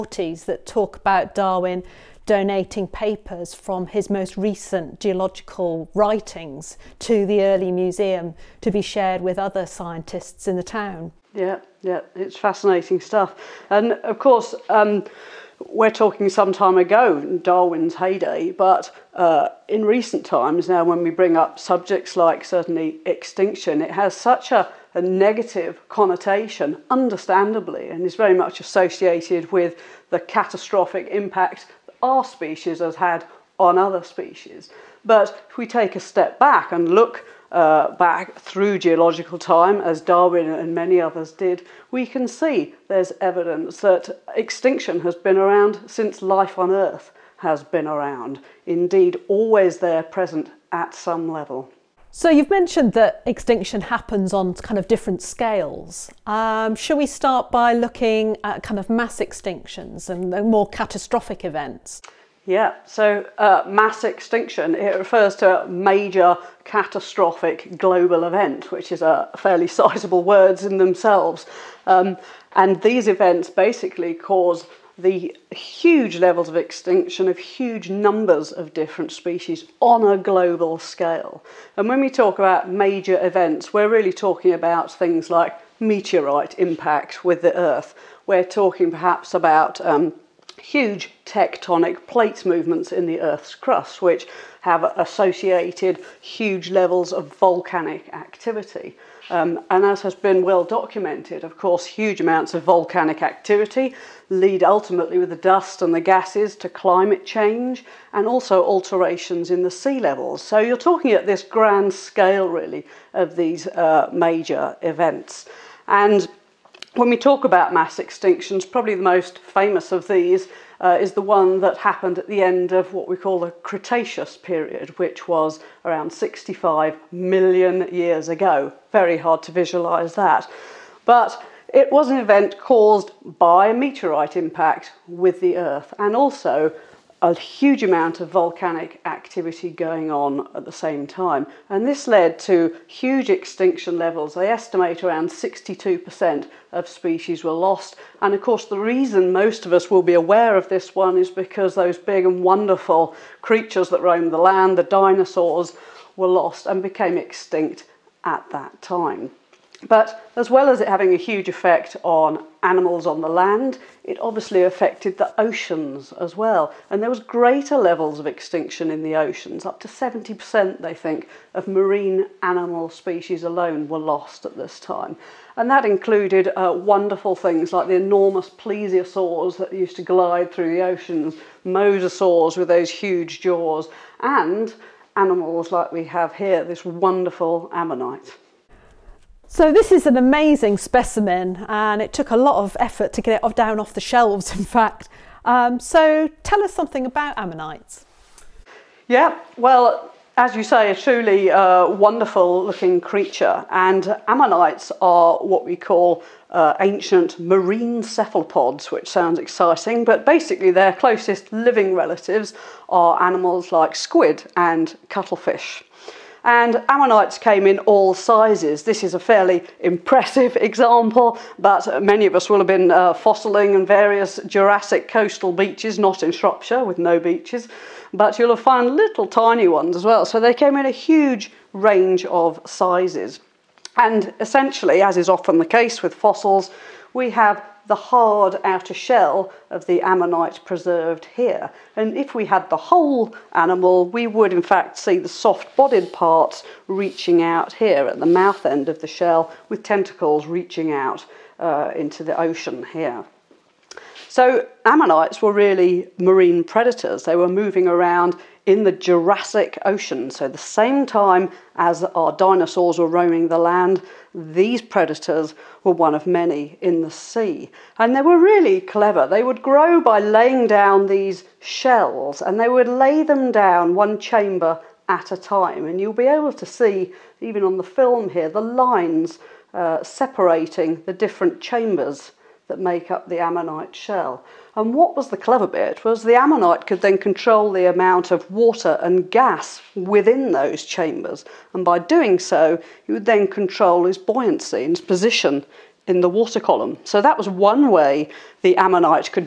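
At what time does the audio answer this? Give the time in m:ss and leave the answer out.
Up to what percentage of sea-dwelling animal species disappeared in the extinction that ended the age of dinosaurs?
2:49.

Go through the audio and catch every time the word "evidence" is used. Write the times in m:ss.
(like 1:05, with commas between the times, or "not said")
0:43.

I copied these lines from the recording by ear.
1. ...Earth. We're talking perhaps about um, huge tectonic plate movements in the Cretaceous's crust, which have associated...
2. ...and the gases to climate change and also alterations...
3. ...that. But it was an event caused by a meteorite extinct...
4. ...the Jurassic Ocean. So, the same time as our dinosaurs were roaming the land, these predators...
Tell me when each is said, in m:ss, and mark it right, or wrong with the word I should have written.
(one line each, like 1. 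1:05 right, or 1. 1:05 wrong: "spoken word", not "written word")
1. 1:27 wrong: "Earth", not "Cretaceous"
2. 1:45 right
3. 2:10 wrong: "impact", not "extinct"
4. 4:18 right.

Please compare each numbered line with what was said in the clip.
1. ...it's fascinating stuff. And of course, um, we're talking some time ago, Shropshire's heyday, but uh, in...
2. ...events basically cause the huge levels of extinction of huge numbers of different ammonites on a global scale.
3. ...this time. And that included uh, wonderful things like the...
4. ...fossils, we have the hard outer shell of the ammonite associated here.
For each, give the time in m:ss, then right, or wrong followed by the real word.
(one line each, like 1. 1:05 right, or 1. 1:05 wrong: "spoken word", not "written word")
1. 0:12 wrong: "Darwin", not "Shropshire"
2. 1:13 wrong: "species", not "ammonites"
3. 2:54 right
4. 3:56 wrong: "preserved", not "associated".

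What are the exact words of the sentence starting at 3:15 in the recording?
Um, so tell us something about ammonites.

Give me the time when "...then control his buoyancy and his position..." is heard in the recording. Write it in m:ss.
4:53.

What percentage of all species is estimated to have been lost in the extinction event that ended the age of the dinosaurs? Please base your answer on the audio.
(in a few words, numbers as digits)
62%.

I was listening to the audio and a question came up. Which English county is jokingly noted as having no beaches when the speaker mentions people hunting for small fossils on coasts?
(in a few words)
Shropshire.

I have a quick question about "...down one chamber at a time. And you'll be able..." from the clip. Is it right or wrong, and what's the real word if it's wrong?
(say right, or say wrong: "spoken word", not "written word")
right.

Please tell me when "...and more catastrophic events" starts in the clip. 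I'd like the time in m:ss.
1:00.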